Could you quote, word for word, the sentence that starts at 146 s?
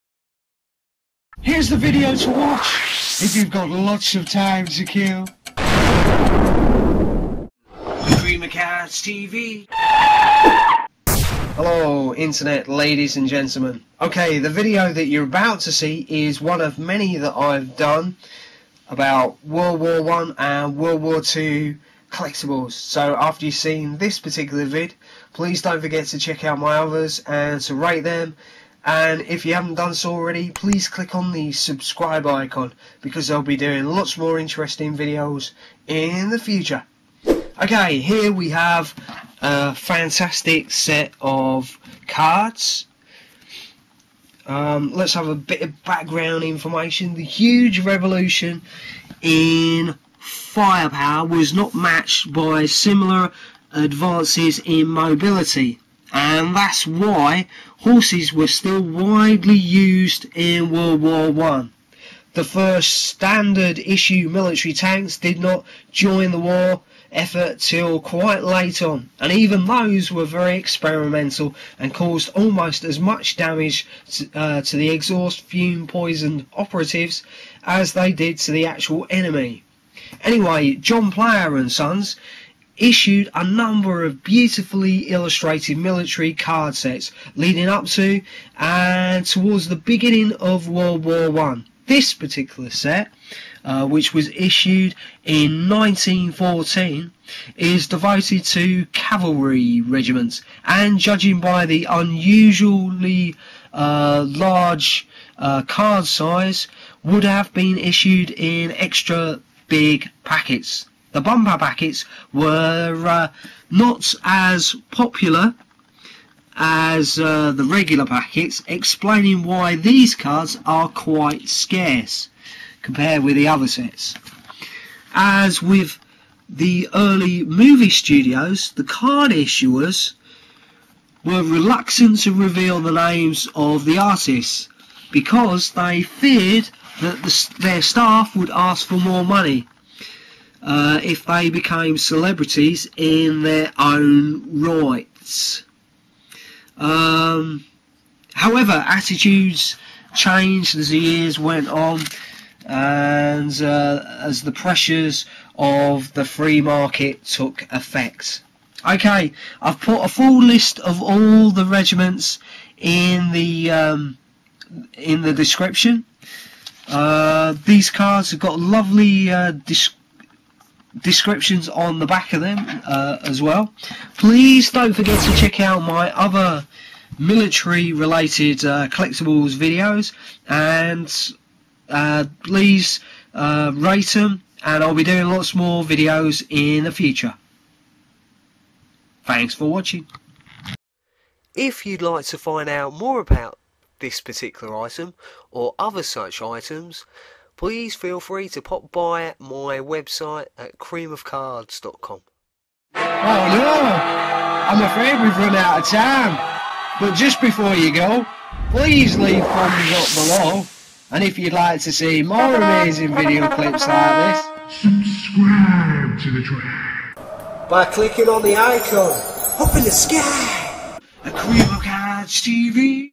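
Um, however, attitudes changed as the years went on, and uh, as the pressures of the free market took effect.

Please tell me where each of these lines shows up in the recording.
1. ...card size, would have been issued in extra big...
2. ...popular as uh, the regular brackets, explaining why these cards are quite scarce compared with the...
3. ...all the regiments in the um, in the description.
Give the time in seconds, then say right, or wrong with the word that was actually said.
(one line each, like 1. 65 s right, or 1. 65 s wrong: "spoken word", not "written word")
1. 105 s right
2. 114 s right
3. 161 s right.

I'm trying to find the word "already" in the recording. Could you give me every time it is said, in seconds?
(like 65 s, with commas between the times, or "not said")
30 s.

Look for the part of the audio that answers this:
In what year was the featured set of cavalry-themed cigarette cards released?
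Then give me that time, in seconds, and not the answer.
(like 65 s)
95 s.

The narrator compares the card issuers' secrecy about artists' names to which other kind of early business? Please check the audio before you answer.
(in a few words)
Early movie studios.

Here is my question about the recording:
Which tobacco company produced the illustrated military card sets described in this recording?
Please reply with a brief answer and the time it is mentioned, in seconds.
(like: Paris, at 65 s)
John Player and Sons, at 80 s.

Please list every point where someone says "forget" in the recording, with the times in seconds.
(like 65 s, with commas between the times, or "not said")
25 s, 174 s.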